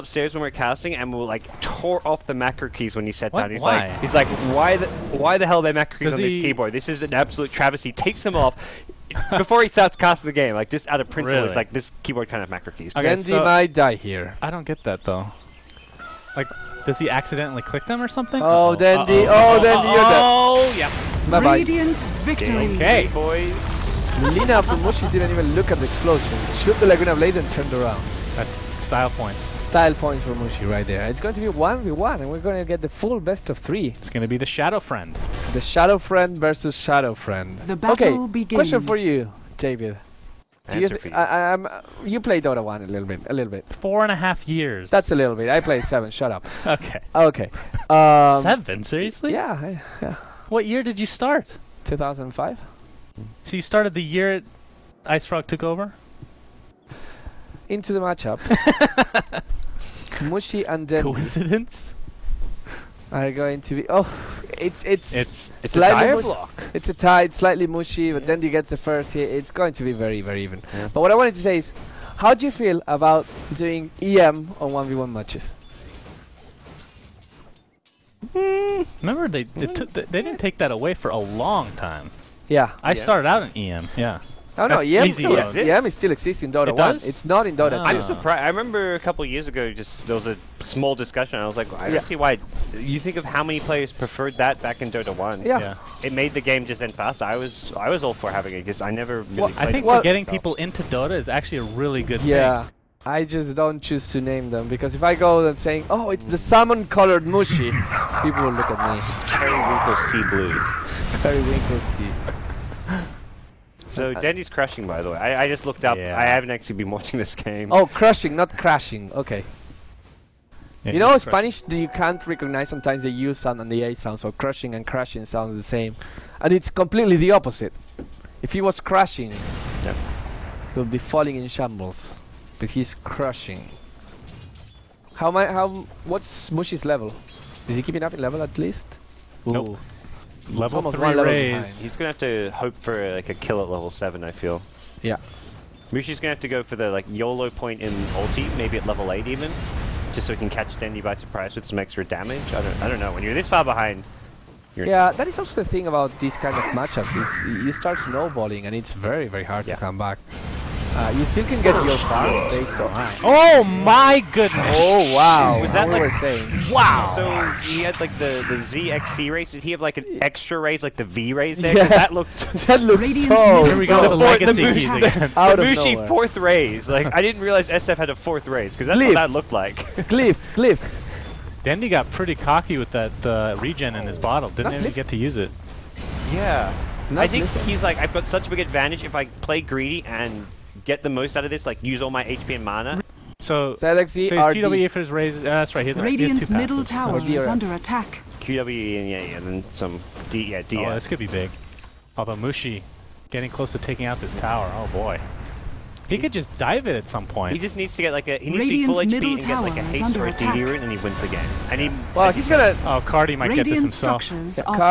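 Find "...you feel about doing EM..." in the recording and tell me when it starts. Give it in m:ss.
1:12.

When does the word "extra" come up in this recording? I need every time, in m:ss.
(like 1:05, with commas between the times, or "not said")
2:31, 2:50.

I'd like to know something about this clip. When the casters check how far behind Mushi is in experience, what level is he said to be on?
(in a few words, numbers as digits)
3.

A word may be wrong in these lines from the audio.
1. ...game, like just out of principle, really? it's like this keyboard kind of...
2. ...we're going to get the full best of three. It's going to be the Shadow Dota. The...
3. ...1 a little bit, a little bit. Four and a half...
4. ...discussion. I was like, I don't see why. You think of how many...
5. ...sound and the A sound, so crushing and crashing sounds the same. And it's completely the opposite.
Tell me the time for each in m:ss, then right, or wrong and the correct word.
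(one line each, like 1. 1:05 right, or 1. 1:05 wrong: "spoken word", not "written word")
1. 0:10 right
2. 0:32 wrong: "Fiend", not "Dota"
3. 0:42 right
4. 1:30 right
5. 2:03 right.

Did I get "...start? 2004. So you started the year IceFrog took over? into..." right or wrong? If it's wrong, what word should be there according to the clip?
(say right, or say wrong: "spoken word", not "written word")
wrong: "2005", not "2004".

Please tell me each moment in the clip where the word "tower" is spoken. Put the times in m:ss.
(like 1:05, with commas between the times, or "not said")
3:16, 3:24.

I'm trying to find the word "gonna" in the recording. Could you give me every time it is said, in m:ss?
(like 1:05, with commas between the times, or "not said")
2:21, 2:26, 3:32.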